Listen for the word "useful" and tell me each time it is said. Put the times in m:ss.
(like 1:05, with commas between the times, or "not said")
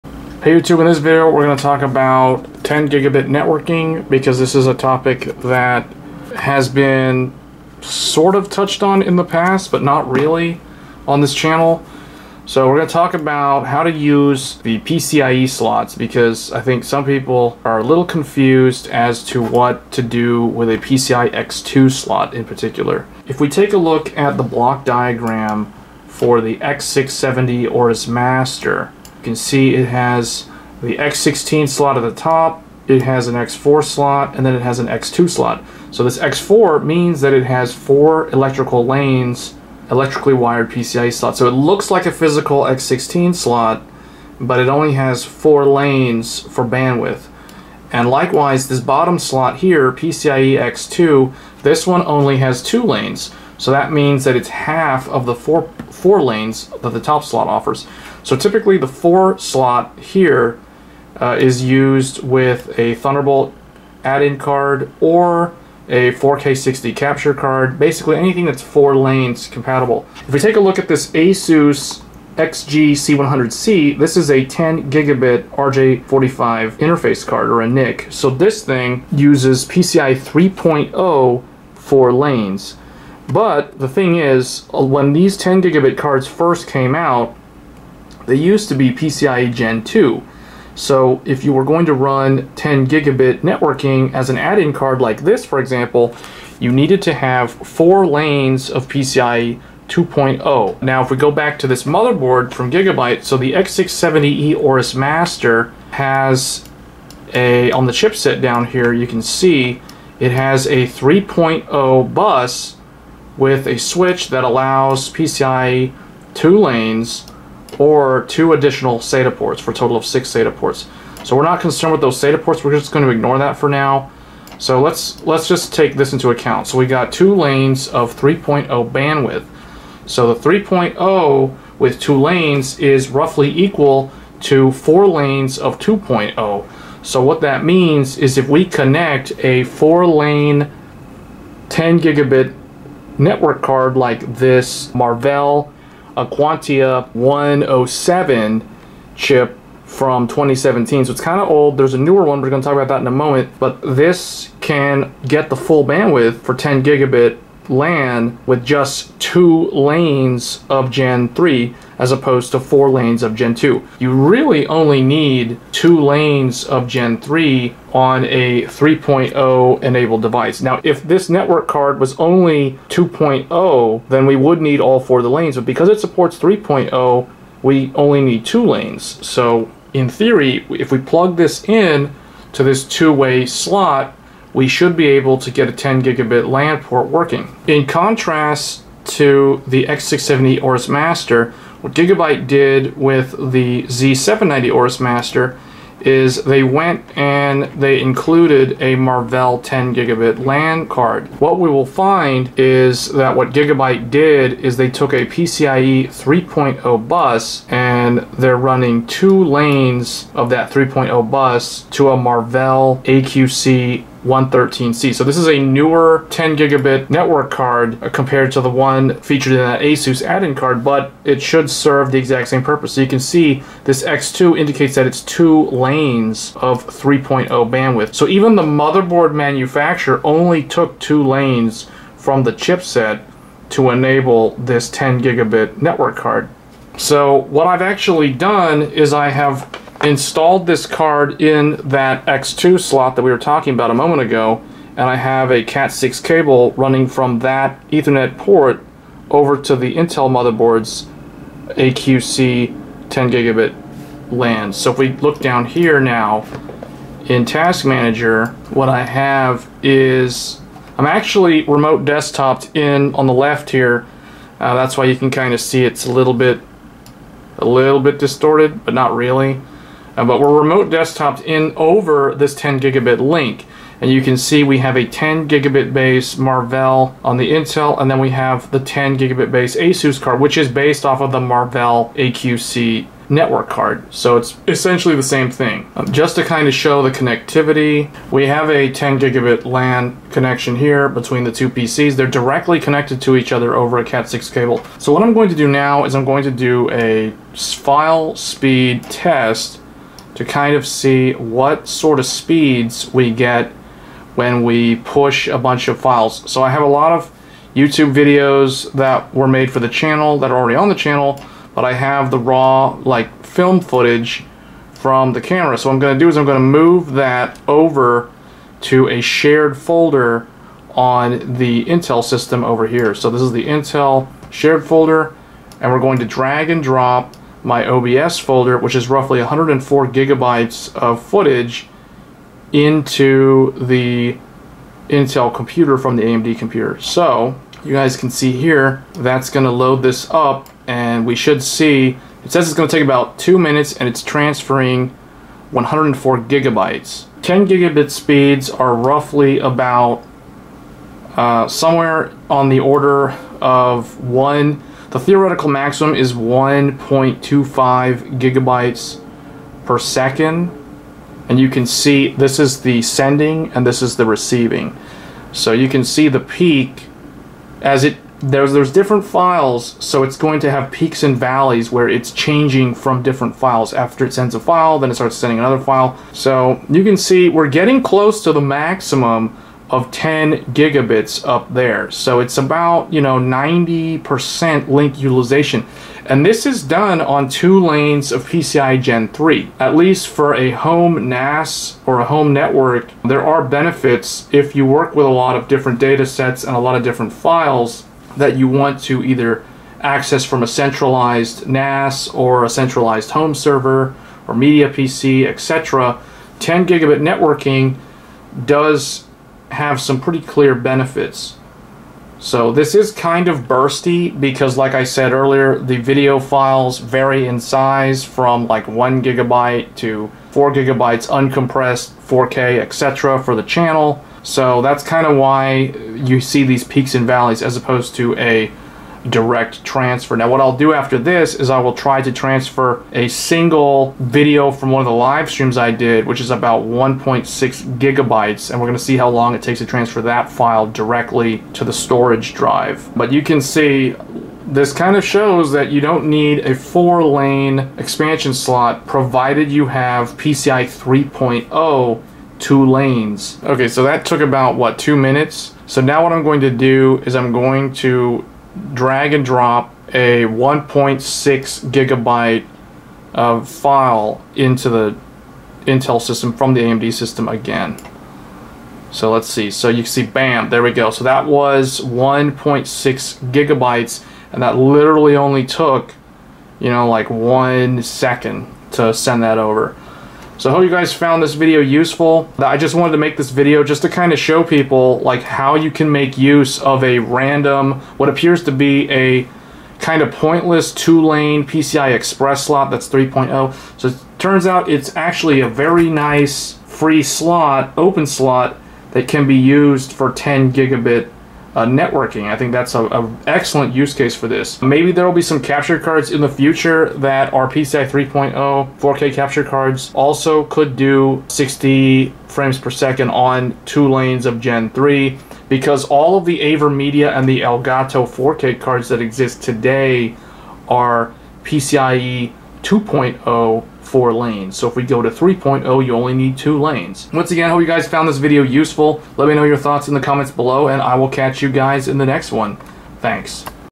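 8:01, 8:48.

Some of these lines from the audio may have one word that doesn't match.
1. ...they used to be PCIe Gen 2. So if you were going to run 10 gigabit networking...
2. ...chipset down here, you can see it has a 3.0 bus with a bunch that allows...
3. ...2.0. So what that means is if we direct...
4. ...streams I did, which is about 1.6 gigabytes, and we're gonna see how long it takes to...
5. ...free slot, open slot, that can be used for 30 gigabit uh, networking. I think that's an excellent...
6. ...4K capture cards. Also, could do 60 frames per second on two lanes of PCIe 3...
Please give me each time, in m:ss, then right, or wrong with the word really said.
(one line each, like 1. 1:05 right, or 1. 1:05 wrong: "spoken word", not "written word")
1. 1:28 right
2. 1:47 wrong: "switch", not "bunch"
3. 2:15 wrong: "connect", not "direct"
4. 7:15 right
5. 8:16 wrong: "10", not "30"
6. 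8:28 wrong: "Gen", not "PCIe".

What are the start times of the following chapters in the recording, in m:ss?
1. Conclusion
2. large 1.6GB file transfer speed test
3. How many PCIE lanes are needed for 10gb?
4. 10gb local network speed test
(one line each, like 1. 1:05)
1. 8:02
2. 7:39
3. 1:10
4. 5:29.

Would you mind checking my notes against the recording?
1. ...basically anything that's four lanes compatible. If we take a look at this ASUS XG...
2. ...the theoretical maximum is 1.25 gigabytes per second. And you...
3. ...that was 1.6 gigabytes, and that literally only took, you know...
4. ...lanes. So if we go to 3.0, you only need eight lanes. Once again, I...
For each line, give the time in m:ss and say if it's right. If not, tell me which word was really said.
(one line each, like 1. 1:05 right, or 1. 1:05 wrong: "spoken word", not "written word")
1. 1:07 right
2. 5:55 right
3. 7:51 right
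4. 8:44 wrong: "two", not "eight".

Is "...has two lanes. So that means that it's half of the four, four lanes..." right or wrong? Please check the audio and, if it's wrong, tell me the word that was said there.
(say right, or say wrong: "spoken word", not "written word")
right.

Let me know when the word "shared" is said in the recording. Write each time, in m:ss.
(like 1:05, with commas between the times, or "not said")
5:19, 5:24.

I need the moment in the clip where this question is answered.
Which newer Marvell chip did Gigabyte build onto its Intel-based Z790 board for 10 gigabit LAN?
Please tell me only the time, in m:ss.
3:33.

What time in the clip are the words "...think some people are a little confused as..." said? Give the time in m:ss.
0:16.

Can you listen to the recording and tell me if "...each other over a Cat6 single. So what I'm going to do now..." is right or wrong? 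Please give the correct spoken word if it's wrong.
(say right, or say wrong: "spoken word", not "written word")
wrong: "cable", not "single".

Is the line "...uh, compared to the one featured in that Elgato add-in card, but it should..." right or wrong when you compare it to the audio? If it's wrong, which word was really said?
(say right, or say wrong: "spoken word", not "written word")
wrong: "ASUS", not "Elgato".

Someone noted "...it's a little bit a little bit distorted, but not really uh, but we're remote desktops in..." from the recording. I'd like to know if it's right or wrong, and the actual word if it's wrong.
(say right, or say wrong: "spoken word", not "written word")
right.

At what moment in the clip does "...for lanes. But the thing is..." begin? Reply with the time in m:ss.
1:21.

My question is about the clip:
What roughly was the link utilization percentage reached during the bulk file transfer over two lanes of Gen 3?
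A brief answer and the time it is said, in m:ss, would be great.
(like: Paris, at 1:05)
90%, at 6:23.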